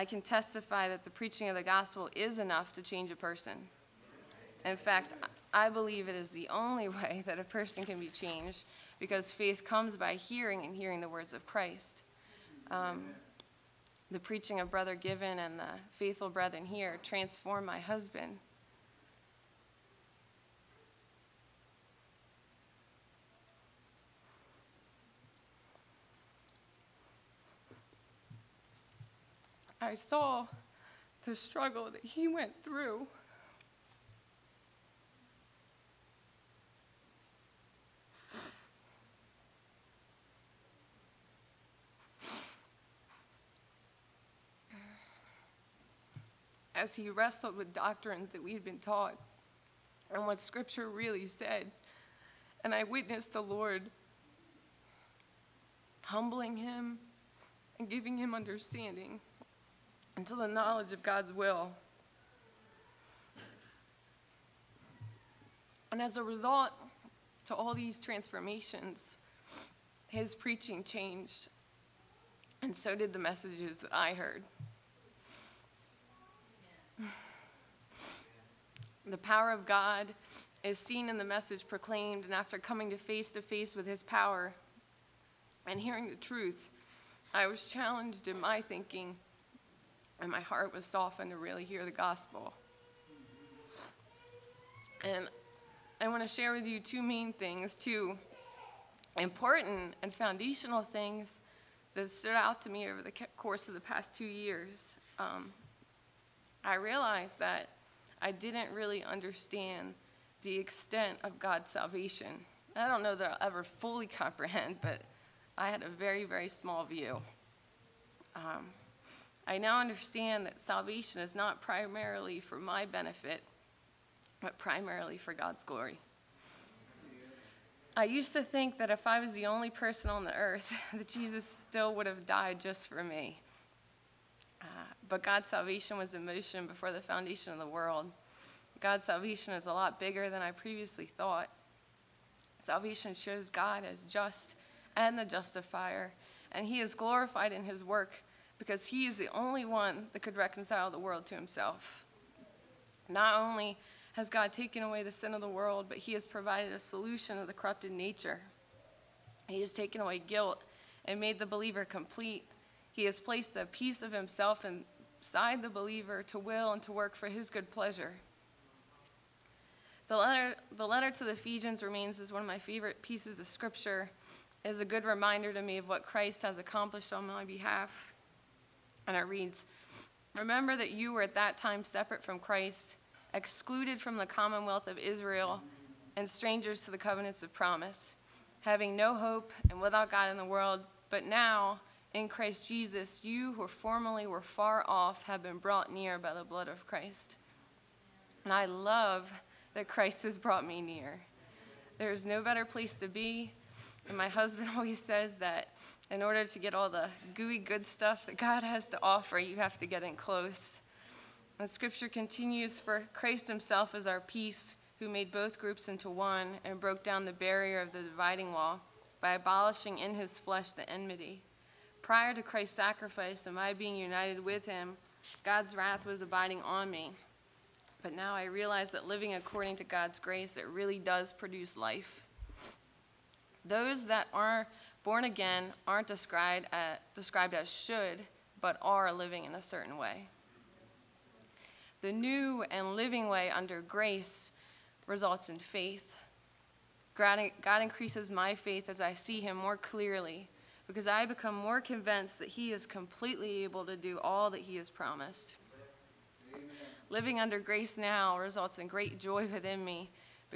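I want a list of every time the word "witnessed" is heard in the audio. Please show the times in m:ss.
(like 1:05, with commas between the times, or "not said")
0:52.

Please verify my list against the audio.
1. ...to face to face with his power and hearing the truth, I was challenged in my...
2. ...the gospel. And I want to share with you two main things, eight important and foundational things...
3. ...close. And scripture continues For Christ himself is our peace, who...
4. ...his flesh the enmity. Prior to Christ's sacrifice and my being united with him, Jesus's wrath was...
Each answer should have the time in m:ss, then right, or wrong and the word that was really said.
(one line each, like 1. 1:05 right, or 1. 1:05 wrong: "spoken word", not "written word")
1. 1:22 right
2. 1:31 wrong: "two", not "eight"
3. 3:30 right
4. 3:40 wrong: "God", not "Jesus".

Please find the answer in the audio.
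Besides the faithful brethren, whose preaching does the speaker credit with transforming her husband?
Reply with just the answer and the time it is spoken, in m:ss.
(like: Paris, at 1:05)
Brother Given, at 0:14.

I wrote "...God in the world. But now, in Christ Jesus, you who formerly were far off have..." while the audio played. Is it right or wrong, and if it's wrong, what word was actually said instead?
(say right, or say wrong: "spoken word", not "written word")
right.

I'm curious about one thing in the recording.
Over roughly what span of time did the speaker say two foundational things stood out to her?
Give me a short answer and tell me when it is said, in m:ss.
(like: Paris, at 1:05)
2 years, at 1:44.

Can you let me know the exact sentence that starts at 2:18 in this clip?
God's salvation is a lot bigger than I previously thought.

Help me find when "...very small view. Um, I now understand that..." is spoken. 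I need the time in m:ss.
1:56.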